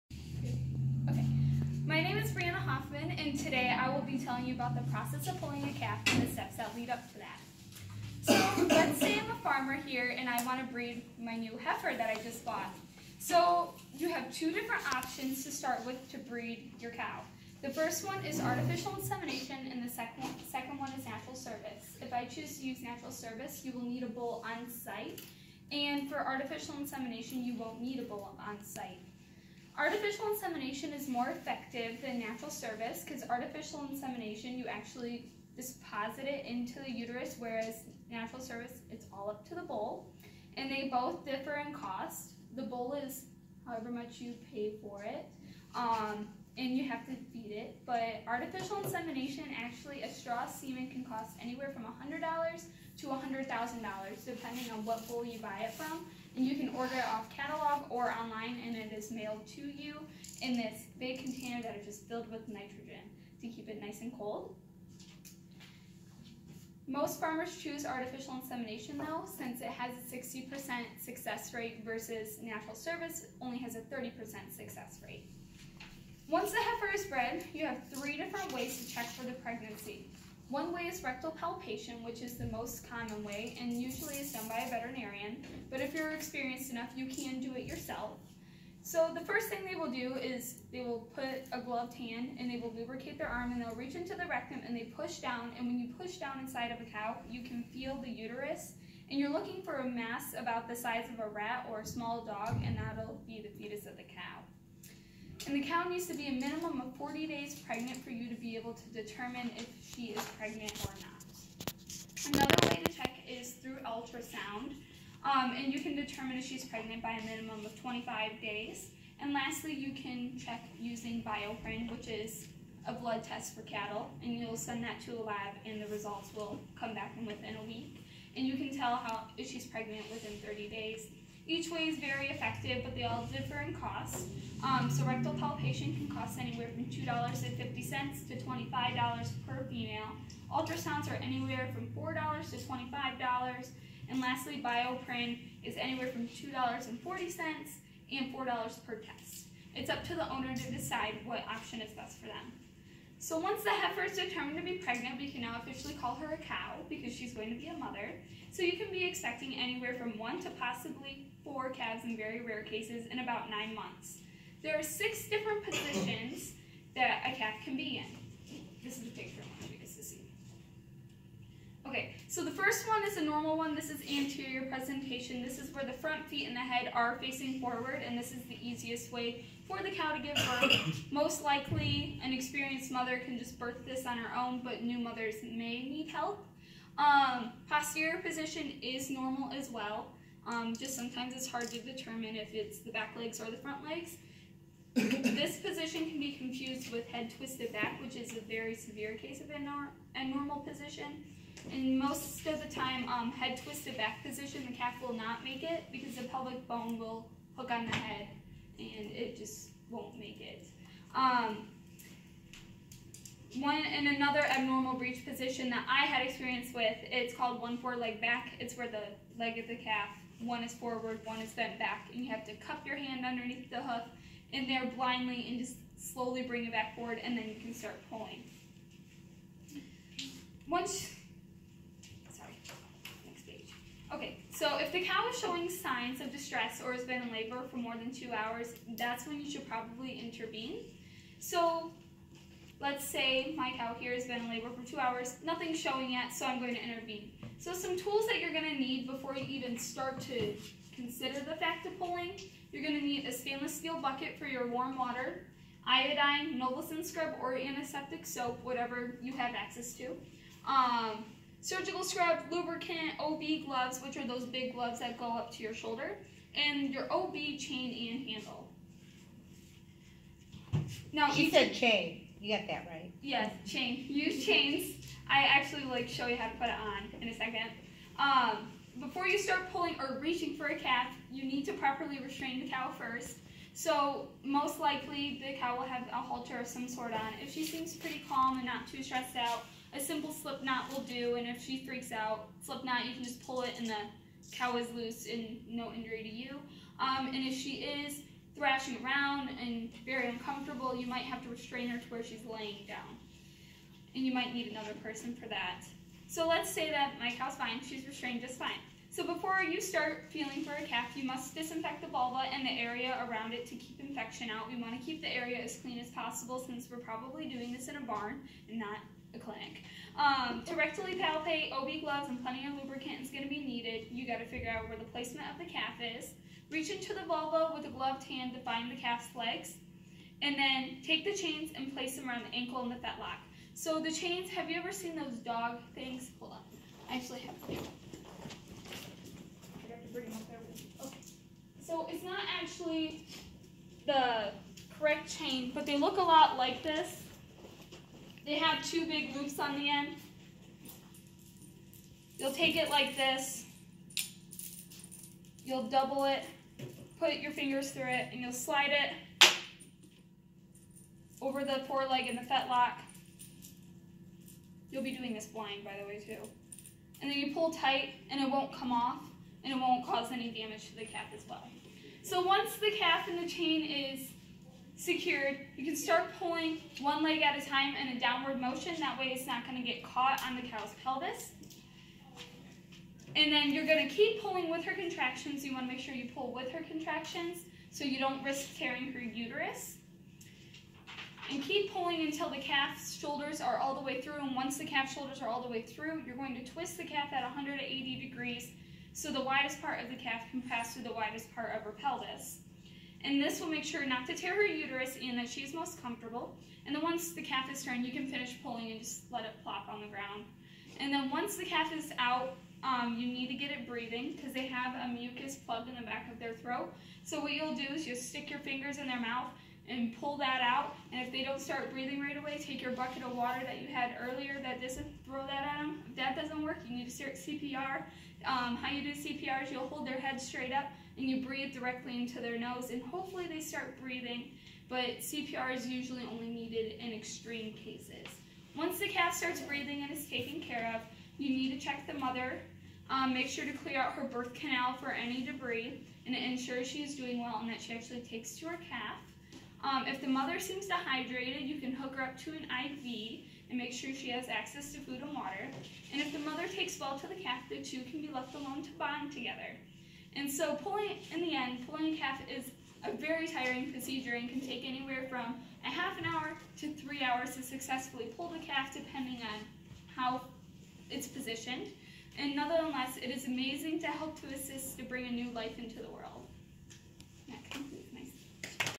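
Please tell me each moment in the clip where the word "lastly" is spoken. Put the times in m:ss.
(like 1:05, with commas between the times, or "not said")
1:59, 2:24.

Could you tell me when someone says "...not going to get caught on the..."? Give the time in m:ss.
6:19.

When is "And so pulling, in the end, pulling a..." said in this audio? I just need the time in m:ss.
7:40.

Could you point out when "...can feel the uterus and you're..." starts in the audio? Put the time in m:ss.
1:37.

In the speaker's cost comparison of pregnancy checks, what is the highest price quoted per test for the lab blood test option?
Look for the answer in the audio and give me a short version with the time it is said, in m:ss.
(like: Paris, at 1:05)
$4, at 2:28.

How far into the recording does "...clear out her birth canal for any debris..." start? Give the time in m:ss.
7:23.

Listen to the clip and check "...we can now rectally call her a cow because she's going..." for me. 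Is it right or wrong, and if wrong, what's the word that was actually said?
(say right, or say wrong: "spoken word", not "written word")
wrong: "officially", not "rectally".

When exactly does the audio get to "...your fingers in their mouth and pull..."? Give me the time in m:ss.
6:58.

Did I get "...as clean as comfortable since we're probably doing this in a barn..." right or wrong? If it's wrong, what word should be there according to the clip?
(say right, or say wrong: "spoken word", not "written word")
wrong: "possible", not "comfortable".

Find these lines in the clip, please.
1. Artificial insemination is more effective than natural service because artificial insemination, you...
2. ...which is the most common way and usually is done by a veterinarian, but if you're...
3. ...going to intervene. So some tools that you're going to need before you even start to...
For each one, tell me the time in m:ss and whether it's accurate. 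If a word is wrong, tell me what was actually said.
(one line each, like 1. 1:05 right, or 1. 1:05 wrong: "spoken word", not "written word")
1. 0:29 right
2. 1:22 right
3. 4:06 right.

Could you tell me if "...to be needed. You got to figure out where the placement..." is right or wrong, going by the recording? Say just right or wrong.
right.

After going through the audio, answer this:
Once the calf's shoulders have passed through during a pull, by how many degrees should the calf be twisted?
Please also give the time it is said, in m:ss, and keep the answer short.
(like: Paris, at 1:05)
180 degrees, at 6:37.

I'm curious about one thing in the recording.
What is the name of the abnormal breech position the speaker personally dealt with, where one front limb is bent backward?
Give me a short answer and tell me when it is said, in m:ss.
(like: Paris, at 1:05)
One foreleg back, at 3:37.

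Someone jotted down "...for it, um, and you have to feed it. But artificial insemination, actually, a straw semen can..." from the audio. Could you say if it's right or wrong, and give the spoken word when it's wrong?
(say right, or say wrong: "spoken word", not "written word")
right.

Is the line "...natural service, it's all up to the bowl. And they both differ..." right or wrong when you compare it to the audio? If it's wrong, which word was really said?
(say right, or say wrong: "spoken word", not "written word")
right.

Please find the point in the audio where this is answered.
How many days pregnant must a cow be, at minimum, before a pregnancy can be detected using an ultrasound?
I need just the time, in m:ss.
1:57.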